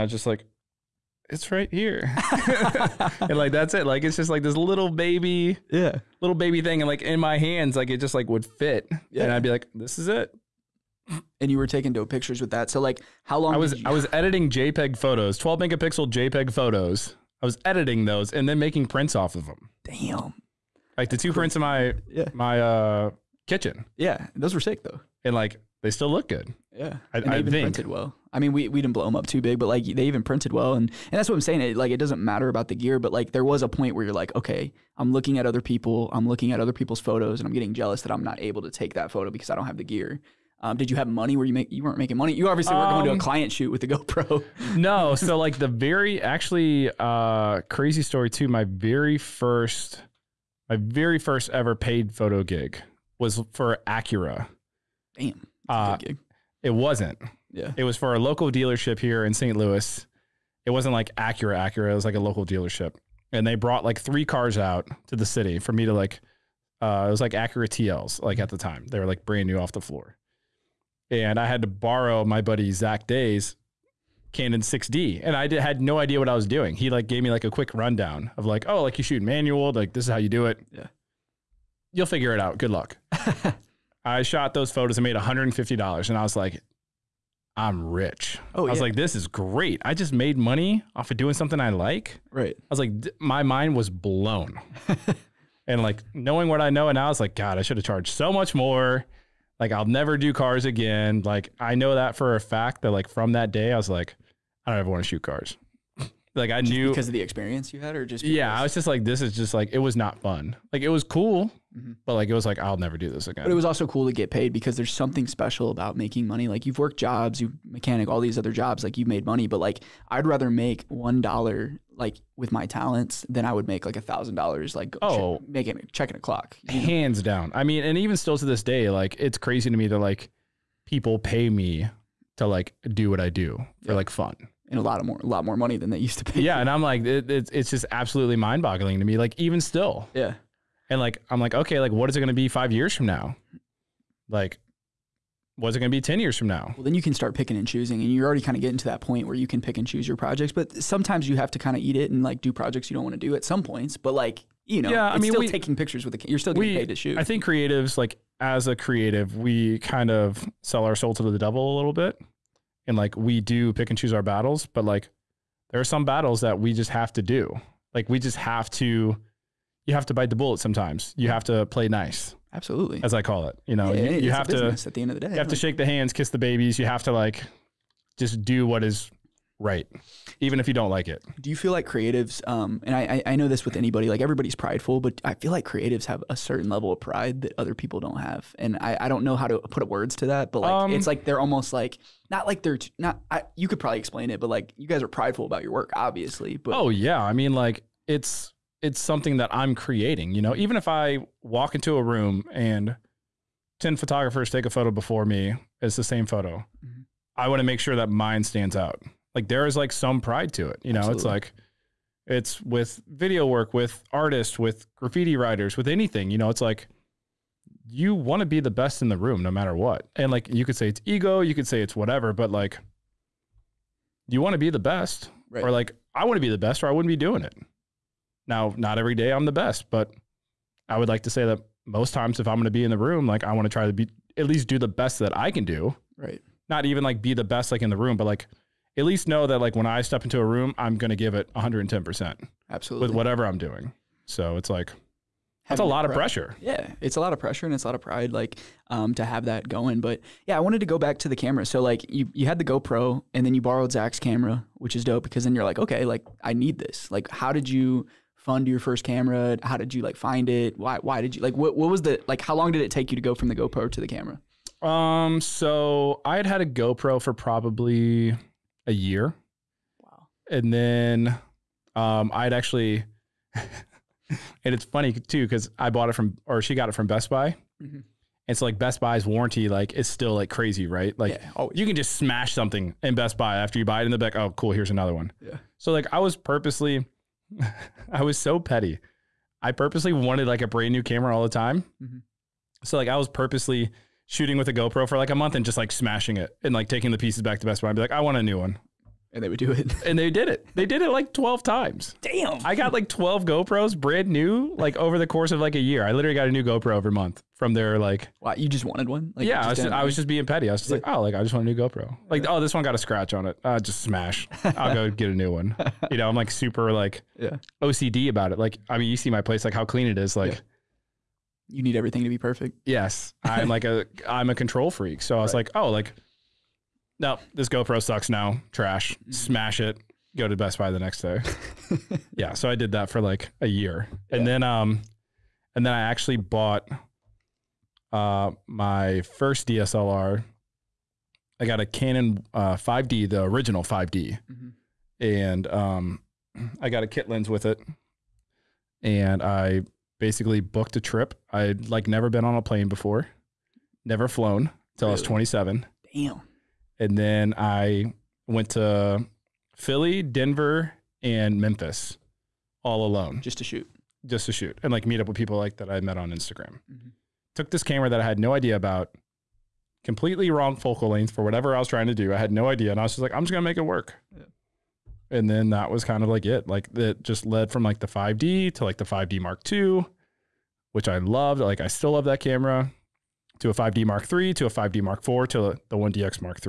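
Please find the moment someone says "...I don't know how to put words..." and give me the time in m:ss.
3:08.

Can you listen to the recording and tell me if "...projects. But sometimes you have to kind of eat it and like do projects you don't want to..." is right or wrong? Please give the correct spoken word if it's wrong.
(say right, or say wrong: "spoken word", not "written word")
right.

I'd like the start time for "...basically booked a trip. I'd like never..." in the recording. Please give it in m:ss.
5:50.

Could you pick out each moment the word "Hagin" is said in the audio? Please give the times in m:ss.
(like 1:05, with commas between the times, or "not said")
not said.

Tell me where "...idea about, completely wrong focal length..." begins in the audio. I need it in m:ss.
6:08.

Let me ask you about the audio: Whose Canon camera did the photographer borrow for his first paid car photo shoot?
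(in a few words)
Zach Day.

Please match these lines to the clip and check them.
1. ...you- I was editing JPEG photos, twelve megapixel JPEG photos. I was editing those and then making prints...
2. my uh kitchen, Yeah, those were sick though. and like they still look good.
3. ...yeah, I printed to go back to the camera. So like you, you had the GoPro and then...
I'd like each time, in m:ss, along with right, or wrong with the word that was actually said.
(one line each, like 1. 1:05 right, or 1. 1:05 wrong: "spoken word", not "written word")
1. 0:13 right
2. 0:22 right
3. 4:10 wrong: "wanted", not "printed".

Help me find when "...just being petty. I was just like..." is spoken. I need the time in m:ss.
5:10.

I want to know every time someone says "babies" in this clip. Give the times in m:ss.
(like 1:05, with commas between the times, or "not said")
2:56.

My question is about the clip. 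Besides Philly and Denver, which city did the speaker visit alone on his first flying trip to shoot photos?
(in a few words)
Memphis.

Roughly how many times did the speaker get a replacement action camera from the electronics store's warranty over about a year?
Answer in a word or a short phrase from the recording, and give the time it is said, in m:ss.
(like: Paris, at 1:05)
12, at 5:01.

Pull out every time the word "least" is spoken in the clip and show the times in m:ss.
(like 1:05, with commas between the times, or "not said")
3:54, 3:59.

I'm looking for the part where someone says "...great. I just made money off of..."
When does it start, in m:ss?
1:29.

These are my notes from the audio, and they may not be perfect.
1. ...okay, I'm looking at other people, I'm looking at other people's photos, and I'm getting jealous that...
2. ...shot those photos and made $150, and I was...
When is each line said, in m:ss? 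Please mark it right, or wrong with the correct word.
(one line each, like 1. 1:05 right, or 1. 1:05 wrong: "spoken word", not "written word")
1. 0:34 right
2. 1:24 right.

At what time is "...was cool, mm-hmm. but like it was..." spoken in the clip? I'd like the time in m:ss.
1:50.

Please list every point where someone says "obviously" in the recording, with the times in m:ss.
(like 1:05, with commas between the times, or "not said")
0:42, 3:15.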